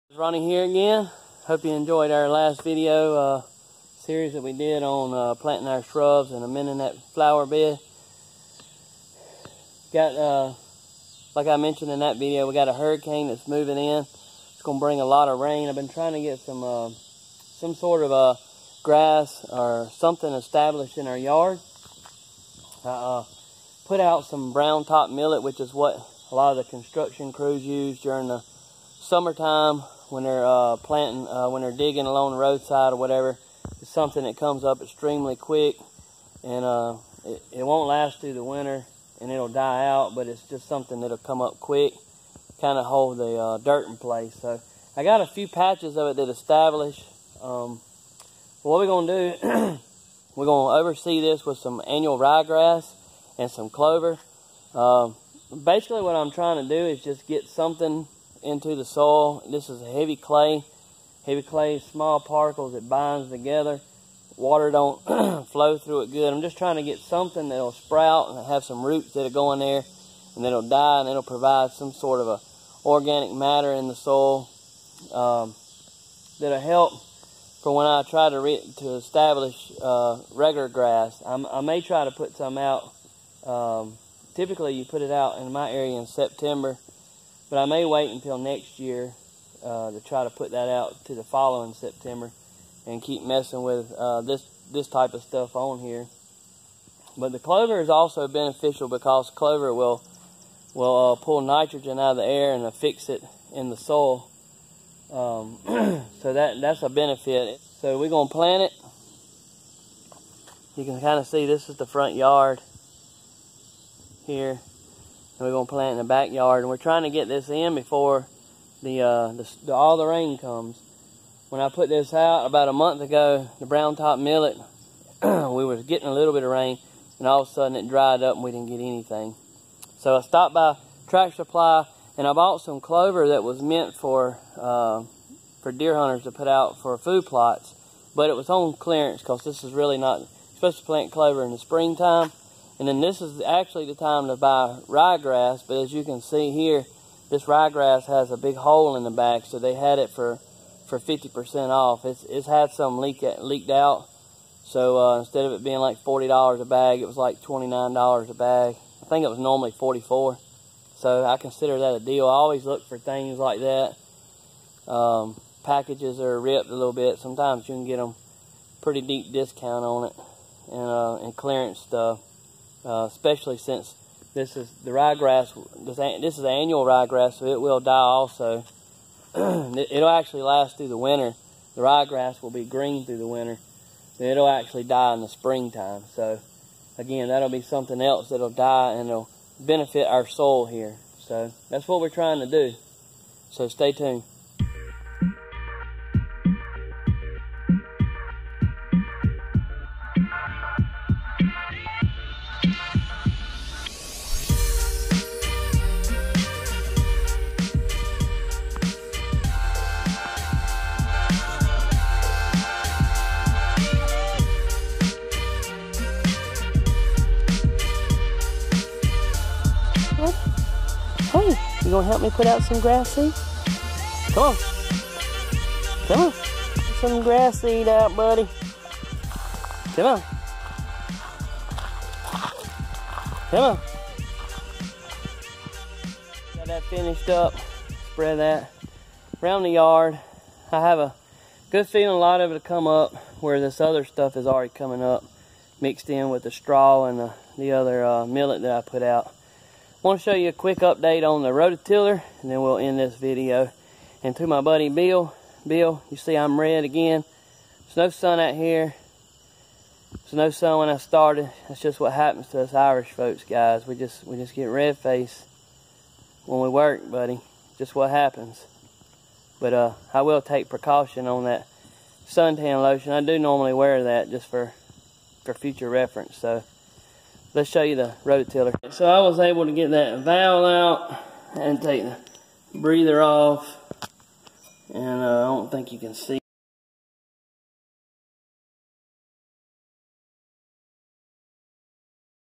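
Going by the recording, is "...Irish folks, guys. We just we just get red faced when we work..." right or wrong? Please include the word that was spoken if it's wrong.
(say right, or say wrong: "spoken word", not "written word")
right.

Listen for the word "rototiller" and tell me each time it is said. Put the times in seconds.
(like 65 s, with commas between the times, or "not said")
251 s, 278 s.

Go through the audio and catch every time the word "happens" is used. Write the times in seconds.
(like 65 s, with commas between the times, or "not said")
262 s, 268 s.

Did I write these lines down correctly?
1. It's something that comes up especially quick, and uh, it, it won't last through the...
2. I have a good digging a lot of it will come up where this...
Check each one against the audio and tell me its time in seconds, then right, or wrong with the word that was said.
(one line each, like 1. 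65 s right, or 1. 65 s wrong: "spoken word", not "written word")
1. 33 s wrong: "extremely", not "especially"
2. 240 s wrong: "feeling", not "digging".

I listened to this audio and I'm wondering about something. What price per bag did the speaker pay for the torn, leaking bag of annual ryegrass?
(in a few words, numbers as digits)
$29.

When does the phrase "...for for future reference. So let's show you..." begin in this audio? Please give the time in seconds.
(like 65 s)
274 s.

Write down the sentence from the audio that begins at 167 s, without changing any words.
Sometimes you can get them pretty deep discount on it and, uh, and clearance stuff uh, especially since this is the ryegrass.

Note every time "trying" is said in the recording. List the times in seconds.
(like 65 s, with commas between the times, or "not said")
15 s, 56 s, 66 s, 116 s, 192 s.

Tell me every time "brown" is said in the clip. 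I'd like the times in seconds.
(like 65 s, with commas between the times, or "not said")
24 s, 123 s.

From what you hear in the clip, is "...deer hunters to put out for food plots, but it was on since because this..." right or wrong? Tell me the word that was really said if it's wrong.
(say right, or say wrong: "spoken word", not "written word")
wrong: "clearance", not "since".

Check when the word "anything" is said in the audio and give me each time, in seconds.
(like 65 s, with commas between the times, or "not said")
128 s.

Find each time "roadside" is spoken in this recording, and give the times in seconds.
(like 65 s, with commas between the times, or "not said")
32 s.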